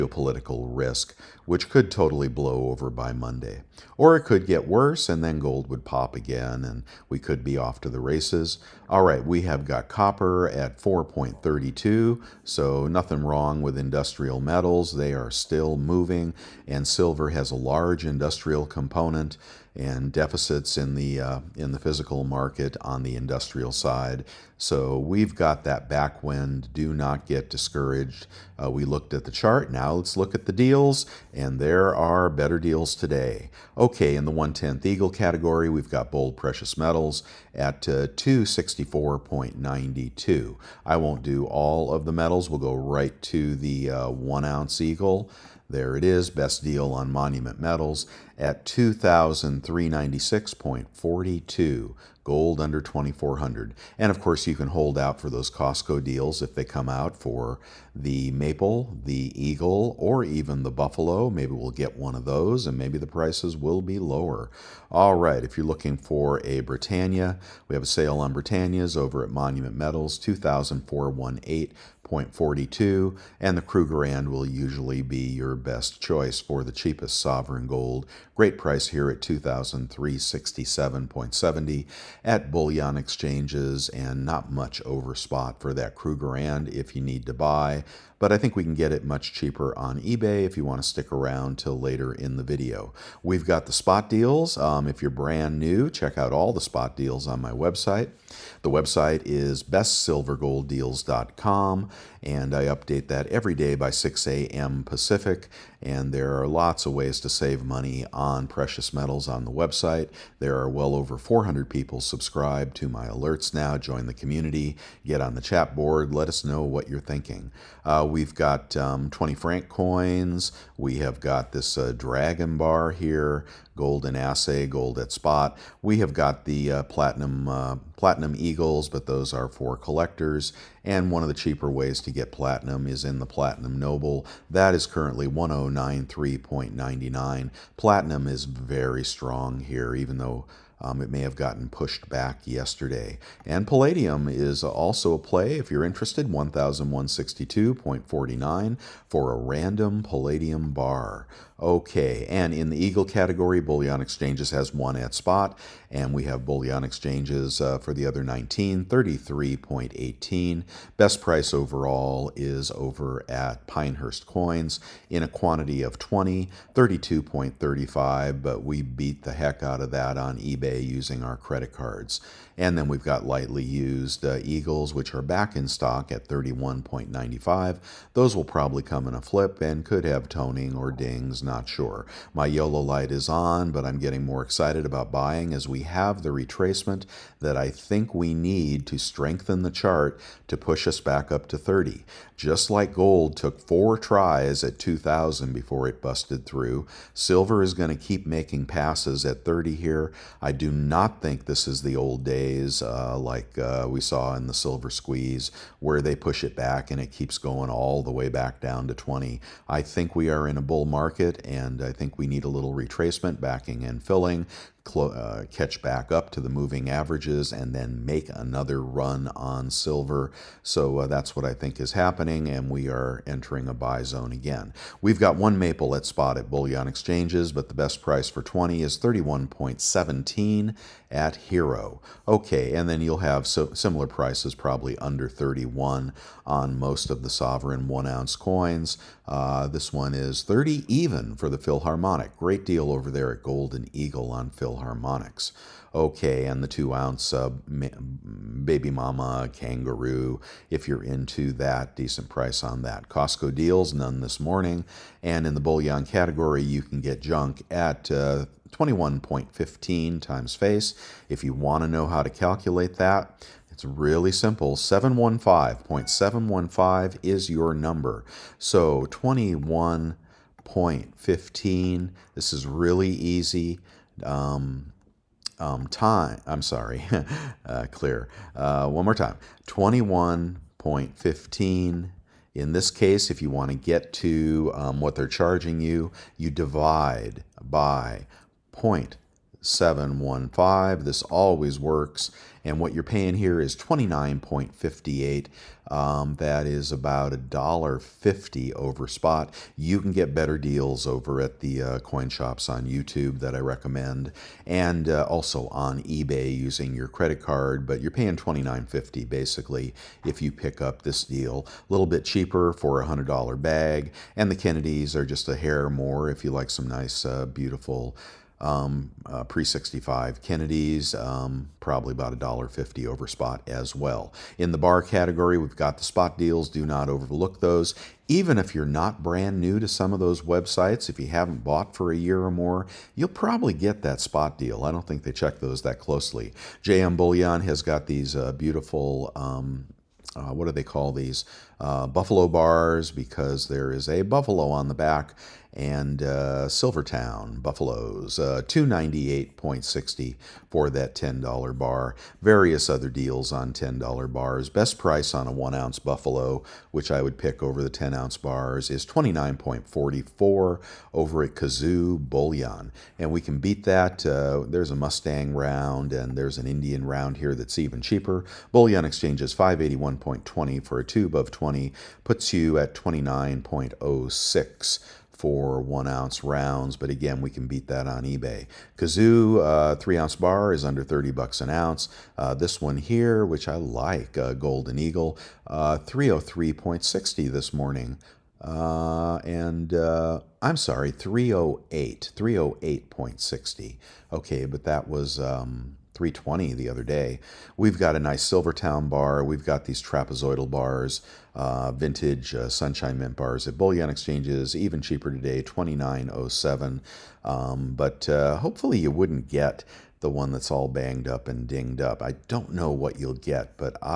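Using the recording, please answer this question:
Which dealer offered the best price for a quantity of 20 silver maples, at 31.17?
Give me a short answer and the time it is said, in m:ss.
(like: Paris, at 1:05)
Hero, at 3:51.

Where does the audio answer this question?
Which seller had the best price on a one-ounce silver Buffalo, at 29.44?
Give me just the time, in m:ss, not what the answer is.
6:01.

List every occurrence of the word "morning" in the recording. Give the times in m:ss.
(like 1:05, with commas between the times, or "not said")
4:14, 6:27.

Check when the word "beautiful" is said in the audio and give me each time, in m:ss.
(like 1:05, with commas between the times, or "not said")
5:17, 5:38.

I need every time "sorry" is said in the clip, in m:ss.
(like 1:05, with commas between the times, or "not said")
4:36, 6:30.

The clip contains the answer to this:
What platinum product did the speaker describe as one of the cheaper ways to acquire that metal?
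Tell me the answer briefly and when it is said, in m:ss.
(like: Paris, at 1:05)
platinum noble, at 2:13.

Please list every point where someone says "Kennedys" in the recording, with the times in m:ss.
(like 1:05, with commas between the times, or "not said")
5:14, 5:20.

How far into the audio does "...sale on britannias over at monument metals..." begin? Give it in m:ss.
1:07.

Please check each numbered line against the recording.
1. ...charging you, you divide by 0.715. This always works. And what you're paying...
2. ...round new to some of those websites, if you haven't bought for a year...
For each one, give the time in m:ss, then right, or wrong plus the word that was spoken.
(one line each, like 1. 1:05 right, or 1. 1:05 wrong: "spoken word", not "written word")
1. 4:45 right
2. 5:29 wrong: "brand", not "round".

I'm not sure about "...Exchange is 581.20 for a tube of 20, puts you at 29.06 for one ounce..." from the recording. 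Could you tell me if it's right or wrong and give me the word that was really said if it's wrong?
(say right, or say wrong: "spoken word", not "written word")
right.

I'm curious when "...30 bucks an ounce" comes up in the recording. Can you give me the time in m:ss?
6:21.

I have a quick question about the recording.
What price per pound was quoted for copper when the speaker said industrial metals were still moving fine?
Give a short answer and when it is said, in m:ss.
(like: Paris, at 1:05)
4.32, at 0:10.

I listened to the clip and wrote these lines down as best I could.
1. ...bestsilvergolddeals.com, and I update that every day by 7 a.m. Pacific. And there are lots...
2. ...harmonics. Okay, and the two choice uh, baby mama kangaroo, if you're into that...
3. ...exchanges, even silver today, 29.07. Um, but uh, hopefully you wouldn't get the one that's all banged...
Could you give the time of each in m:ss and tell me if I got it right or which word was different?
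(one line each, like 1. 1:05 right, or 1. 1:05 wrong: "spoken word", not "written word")
1. 1:39 wrong: "6", not "7"
2. 4:04 wrong: "ounce", not "choice"
3. 6:44 wrong: "cheaper", not "silver".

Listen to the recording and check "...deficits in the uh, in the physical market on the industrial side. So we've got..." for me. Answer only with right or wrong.
right.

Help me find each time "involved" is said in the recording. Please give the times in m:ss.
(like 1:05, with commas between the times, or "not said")
not said.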